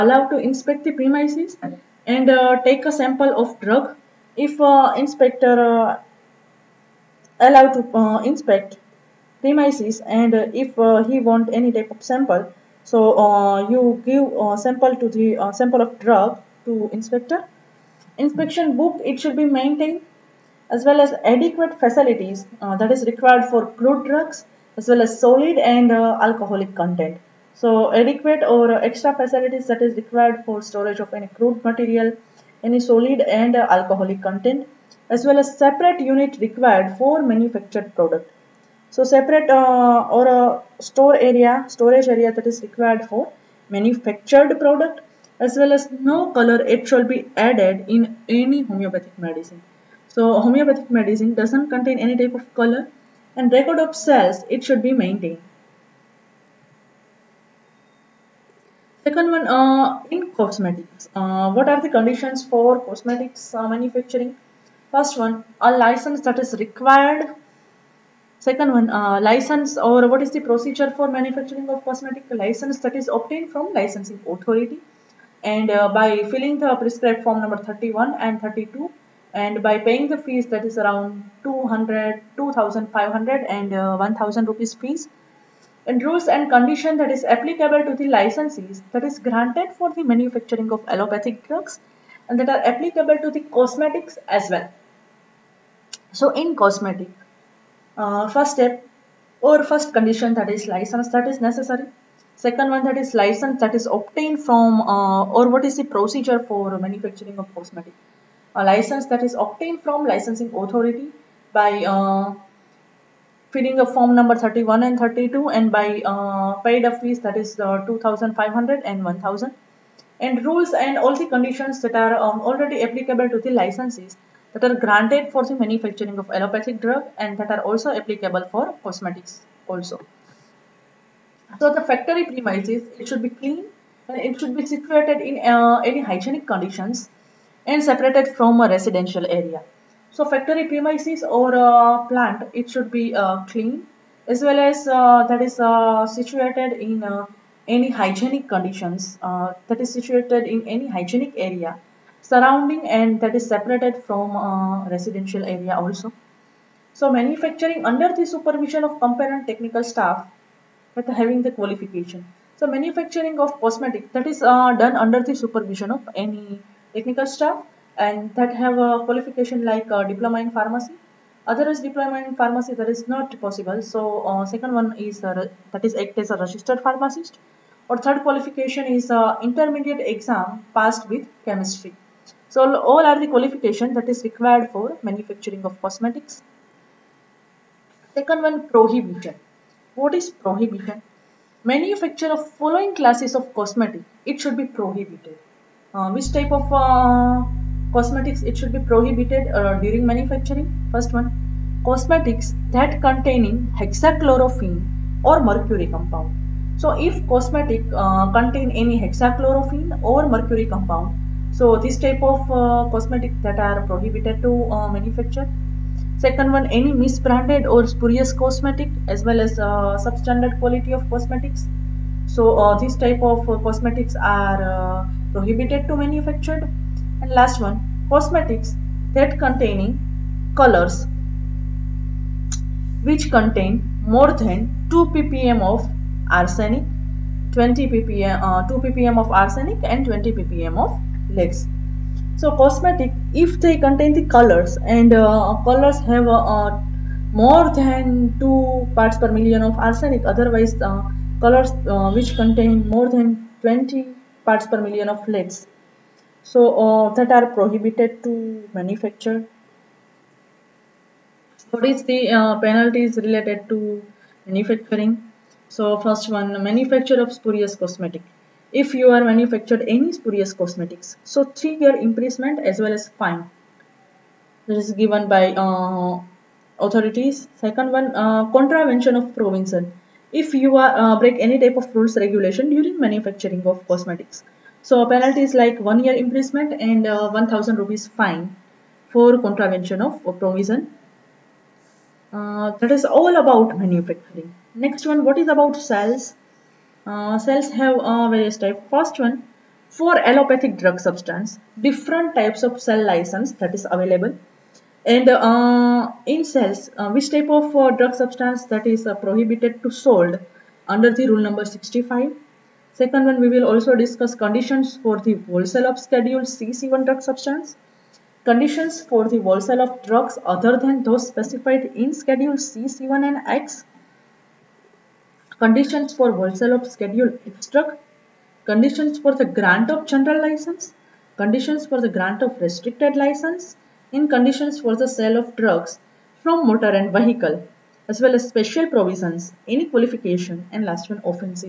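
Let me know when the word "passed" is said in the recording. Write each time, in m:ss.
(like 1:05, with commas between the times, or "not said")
3:00.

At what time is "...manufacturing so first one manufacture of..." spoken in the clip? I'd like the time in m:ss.
4:24.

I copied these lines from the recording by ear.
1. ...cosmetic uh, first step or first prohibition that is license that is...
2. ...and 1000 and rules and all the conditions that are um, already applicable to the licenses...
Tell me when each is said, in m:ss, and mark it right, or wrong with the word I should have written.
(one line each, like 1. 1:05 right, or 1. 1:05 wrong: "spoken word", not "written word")
1. 1:36 wrong: "condition", not "prohibition"
2. 1:58 right.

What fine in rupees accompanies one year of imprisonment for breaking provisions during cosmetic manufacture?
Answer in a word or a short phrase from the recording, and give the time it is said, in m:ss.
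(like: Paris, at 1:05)
1000 rupees, at 4:47.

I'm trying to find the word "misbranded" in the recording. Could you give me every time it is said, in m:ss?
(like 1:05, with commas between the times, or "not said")
3:36.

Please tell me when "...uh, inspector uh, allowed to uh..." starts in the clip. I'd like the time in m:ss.
0:04.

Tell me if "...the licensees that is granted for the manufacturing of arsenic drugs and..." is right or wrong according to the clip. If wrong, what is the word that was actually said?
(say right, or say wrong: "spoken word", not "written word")
wrong: "allopathic", not "arsenic".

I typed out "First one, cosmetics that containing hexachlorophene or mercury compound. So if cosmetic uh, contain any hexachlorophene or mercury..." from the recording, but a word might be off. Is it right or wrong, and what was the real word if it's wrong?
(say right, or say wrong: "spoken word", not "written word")
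right.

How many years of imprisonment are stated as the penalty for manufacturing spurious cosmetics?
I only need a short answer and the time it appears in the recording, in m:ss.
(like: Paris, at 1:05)
3 years, at 4:31.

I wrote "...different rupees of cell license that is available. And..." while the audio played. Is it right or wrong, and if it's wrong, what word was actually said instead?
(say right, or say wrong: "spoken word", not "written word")
wrong: "types", not "rupees".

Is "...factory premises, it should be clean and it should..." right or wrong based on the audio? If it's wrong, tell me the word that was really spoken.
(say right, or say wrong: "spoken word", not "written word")
right.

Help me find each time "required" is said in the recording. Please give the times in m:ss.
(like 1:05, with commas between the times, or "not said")
0:23, 0:29, 0:36, 0:42, 1:06, 3:04.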